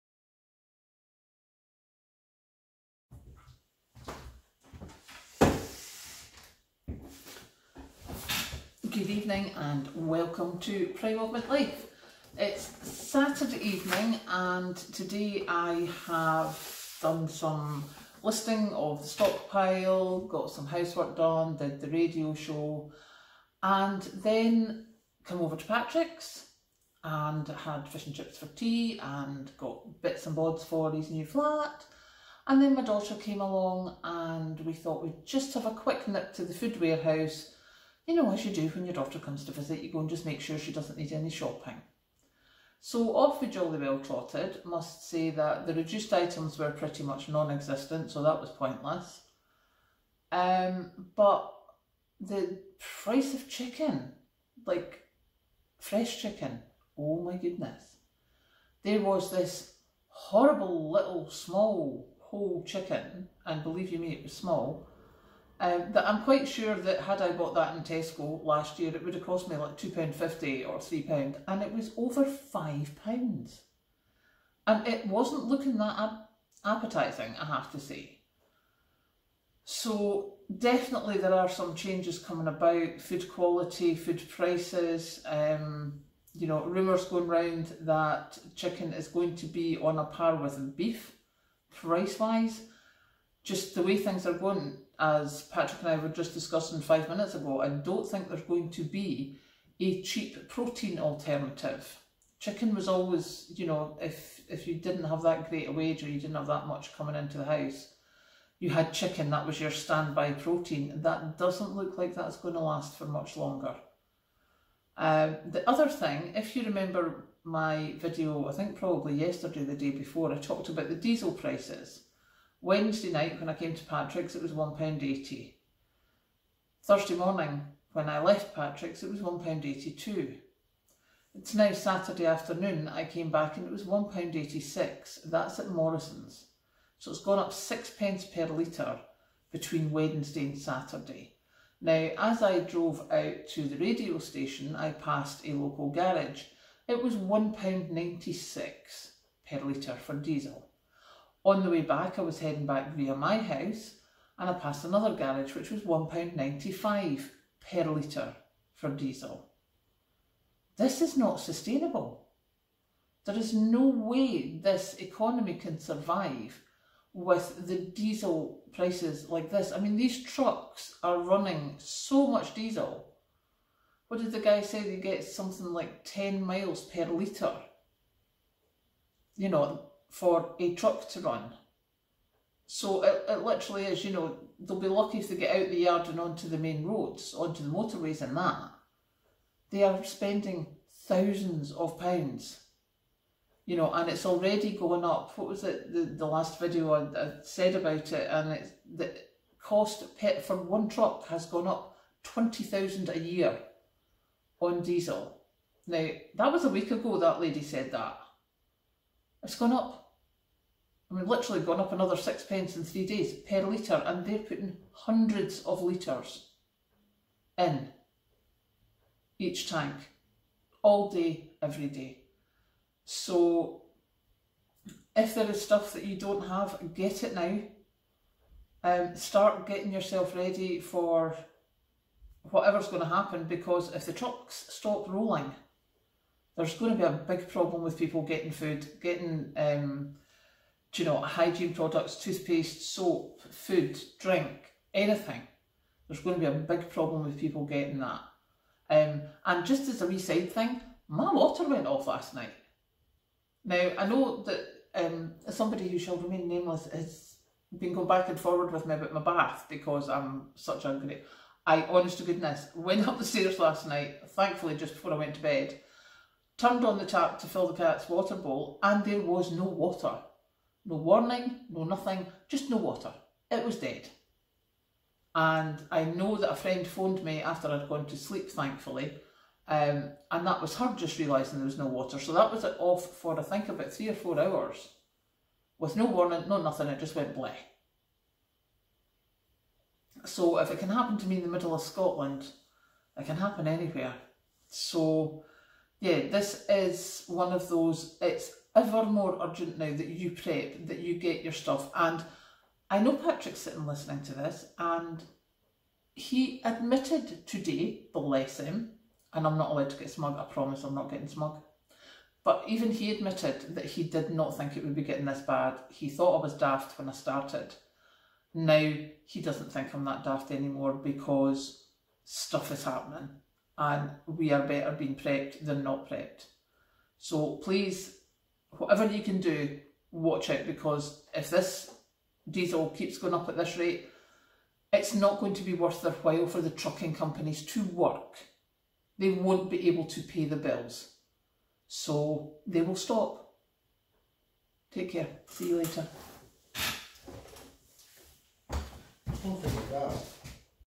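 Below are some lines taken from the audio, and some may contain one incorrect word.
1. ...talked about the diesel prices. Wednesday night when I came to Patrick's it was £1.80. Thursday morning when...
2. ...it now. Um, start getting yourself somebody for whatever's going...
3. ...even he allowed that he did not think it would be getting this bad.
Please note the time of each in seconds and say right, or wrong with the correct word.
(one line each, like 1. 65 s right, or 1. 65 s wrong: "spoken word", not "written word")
1. 120 s right
2. 227 s wrong: "ready", not "somebody"
3. 312 s wrong: "admitted", not "allowed".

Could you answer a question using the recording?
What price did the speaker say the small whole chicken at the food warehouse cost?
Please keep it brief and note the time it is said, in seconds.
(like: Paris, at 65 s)
over £5, at 71 s.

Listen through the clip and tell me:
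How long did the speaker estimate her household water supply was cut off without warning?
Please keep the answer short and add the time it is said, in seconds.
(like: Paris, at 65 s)
3 or 4 hours, at 283 s.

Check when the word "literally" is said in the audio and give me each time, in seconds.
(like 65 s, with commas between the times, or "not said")
183 s, 211 s.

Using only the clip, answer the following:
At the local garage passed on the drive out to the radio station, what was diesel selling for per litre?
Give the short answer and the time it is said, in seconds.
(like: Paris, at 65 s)
£1.96, at 147 s.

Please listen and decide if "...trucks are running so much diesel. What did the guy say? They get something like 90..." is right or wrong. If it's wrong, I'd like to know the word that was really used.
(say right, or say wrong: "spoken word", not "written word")
wrong: "10", not "90".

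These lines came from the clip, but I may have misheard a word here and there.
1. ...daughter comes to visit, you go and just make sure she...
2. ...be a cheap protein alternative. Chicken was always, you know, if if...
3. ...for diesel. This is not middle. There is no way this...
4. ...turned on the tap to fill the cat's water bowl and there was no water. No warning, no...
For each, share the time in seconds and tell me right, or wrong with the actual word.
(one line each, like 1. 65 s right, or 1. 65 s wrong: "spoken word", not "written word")
1. 38 s right
2. 98 s right
3. 158 s wrong: "sustainable", not "middle"
4. 266 s right.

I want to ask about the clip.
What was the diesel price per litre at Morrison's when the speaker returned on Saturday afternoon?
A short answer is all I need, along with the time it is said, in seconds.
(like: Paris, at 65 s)
£1.86, at 133 s.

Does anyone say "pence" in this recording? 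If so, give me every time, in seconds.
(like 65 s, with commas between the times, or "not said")
137 s, 212 s.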